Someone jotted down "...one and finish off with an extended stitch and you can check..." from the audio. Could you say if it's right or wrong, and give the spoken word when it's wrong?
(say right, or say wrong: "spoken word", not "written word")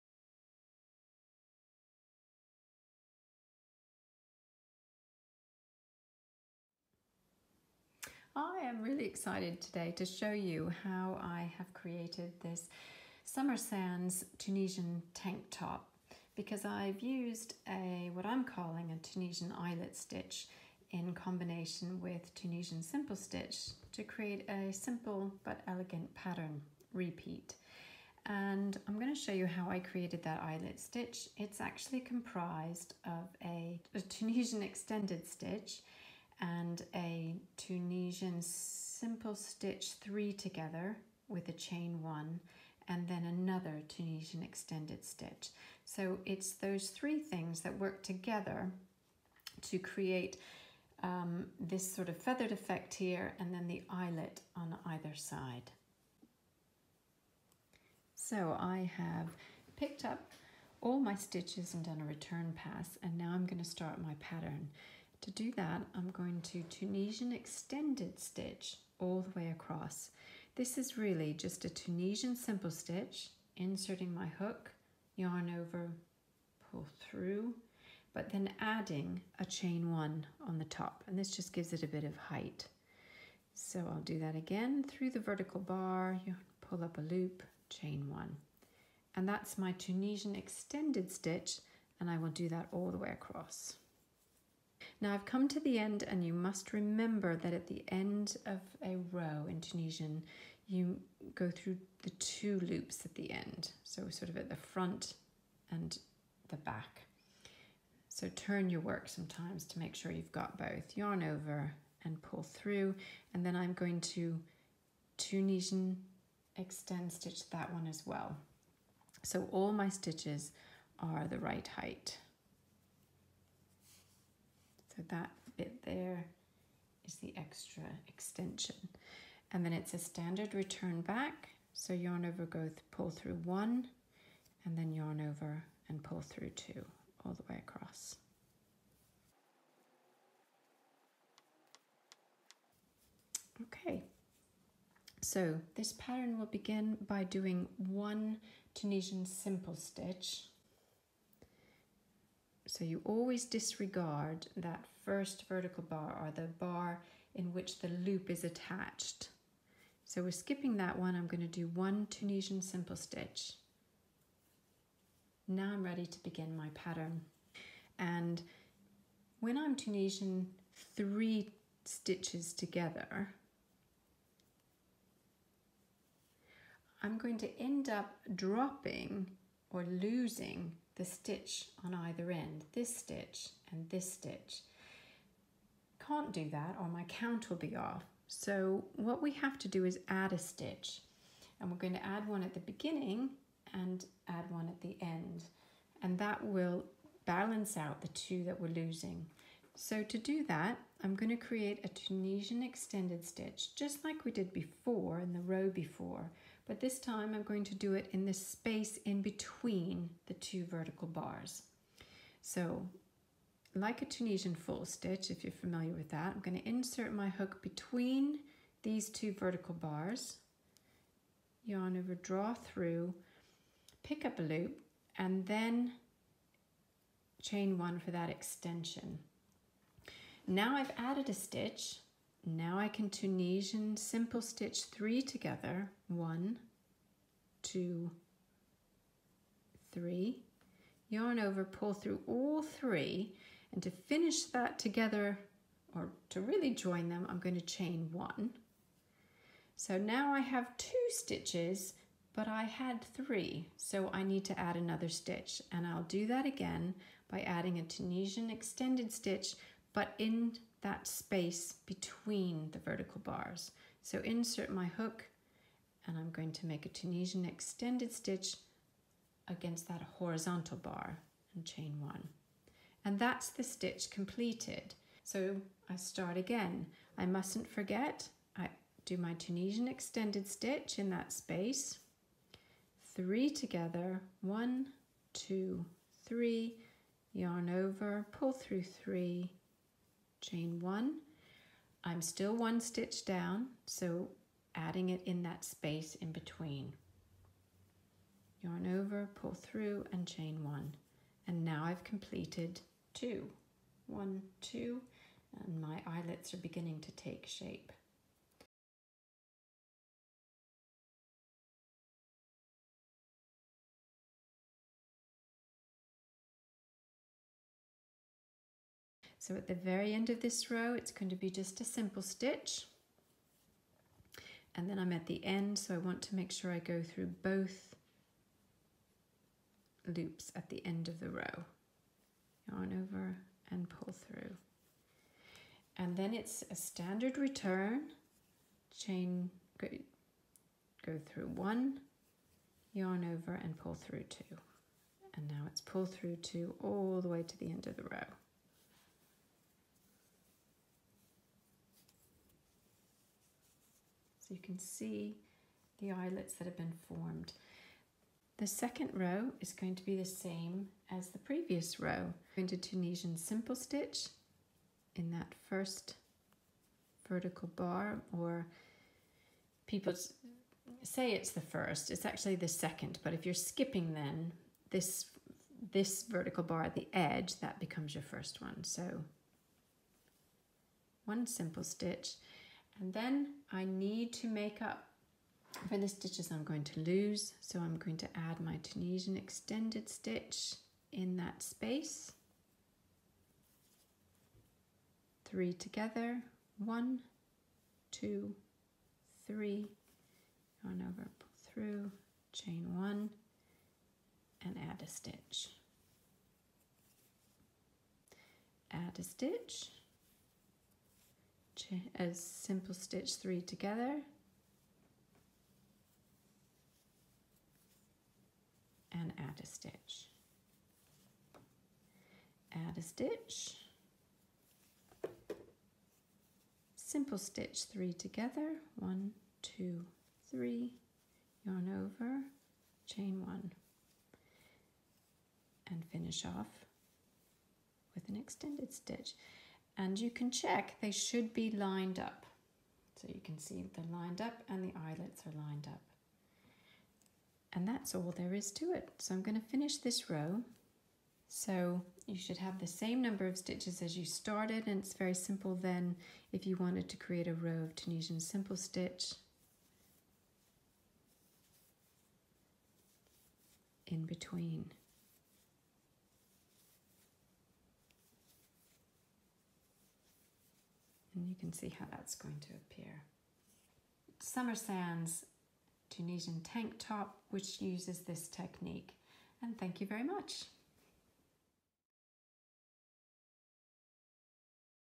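right.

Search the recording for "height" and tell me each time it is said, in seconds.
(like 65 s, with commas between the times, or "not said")
82 s, 121 s.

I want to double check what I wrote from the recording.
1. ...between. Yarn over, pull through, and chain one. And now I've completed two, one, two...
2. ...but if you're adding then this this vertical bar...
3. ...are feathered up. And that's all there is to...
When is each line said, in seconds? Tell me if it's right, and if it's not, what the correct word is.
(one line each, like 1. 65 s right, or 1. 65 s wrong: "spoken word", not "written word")
1. 296 s right
2. 373 s wrong: "skipping", not "adding"
3. 445 s wrong: "lined", not "feathered".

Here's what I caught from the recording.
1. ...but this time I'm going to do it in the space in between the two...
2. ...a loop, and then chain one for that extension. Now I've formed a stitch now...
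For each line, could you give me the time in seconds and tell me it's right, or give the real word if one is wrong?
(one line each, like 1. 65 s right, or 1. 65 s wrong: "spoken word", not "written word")
1. 206 s right
2. 224 s wrong: "added", not "formed".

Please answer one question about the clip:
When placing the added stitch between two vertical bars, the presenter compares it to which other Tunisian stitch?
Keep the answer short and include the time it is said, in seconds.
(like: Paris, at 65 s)
Tunisian full stitch, at 214 s.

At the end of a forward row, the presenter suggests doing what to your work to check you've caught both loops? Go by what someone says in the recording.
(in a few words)
turn your work.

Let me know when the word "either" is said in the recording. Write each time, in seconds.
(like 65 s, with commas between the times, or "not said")
54 s, 181 s.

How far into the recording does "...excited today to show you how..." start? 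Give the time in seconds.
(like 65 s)
9 s.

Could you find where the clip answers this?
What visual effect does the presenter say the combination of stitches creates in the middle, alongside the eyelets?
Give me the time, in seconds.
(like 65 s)
52 s.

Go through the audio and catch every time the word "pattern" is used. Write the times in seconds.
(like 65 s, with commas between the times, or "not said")
26 s, 64 s, 145 s, 166 s.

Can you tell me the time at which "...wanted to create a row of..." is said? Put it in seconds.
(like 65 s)
456 s.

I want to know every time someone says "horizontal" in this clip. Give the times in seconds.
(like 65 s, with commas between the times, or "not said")
270 s.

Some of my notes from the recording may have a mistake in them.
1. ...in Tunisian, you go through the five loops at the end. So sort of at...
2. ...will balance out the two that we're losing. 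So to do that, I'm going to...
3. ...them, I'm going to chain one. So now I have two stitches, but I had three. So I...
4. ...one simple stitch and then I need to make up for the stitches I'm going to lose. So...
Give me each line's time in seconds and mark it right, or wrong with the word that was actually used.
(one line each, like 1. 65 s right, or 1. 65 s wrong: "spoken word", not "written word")
1. 99 s wrong: "two", not "five"
2. 196 s right
3. 247 s right
4. 381 s right.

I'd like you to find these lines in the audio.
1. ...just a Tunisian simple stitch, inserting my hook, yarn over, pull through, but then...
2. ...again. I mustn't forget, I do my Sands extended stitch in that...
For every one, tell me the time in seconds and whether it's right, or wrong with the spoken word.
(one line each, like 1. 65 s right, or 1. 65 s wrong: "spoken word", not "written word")
1. 71 s right
2. 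276 s wrong: "Tunisian", not "Sands".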